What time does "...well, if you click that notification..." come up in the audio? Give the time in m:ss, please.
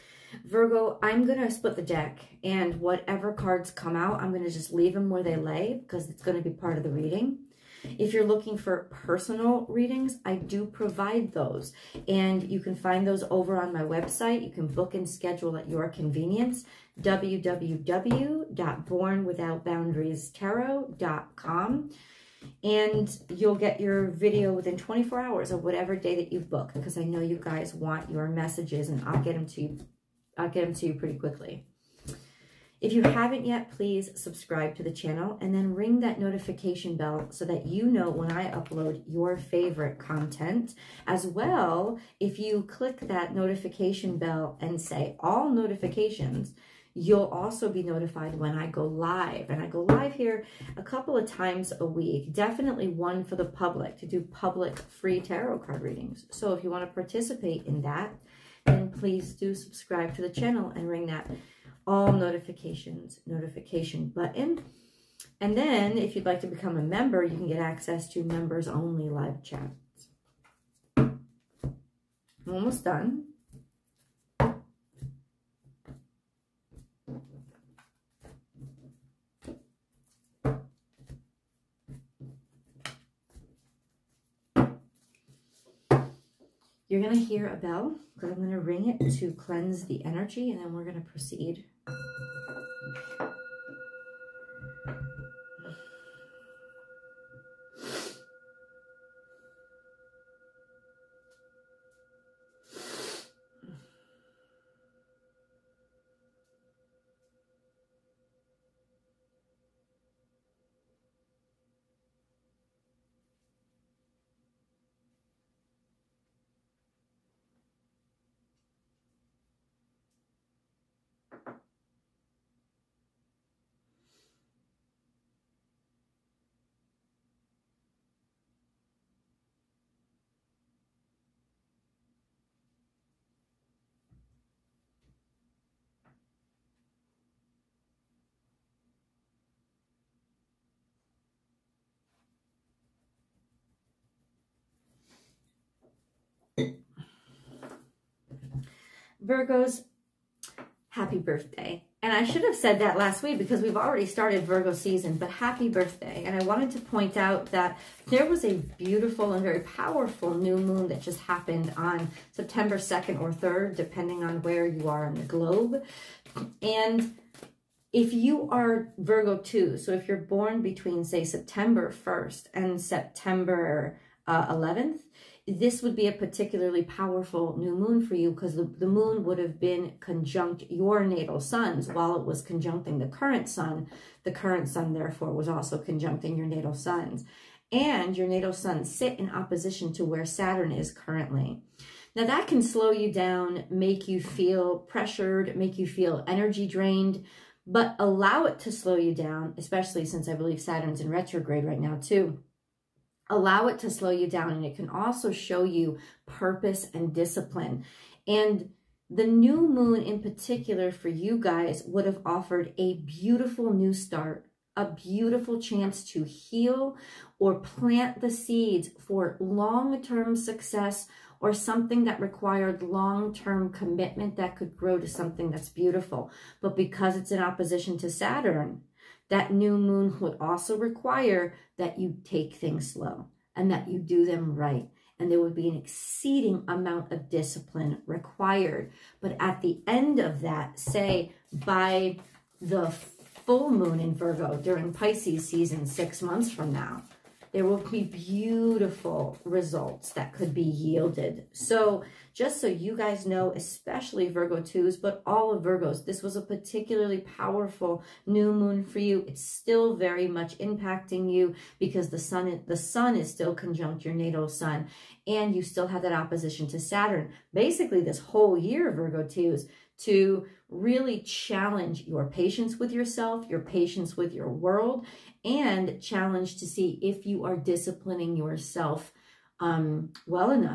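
0:41.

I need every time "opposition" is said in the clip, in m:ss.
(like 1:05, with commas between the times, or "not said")
3:09, 3:47, 4:26.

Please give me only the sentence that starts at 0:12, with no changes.
And you can find those over on my website.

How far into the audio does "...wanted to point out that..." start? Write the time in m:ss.
2:36.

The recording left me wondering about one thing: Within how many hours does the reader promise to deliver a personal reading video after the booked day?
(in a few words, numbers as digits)
24.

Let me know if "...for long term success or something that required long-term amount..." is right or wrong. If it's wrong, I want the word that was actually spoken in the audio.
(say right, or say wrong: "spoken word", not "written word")
wrong: "commitment", not "amount".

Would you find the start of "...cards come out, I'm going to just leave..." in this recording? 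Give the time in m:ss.
0:03.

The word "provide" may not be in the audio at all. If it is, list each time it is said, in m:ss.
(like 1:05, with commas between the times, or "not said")
0:10.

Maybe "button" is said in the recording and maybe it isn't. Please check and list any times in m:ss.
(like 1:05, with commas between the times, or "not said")
1:04.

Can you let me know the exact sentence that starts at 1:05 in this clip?
And then if you'd like to become a member, you can get access to members only live chats.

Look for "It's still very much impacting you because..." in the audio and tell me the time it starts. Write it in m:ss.
4:19.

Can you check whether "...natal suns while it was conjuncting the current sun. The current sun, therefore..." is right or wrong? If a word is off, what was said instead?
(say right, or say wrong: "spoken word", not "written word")
right.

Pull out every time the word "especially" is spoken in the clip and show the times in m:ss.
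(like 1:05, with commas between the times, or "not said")
3:19, 4:13.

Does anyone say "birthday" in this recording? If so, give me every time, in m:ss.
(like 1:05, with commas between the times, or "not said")
2:31, 2:35.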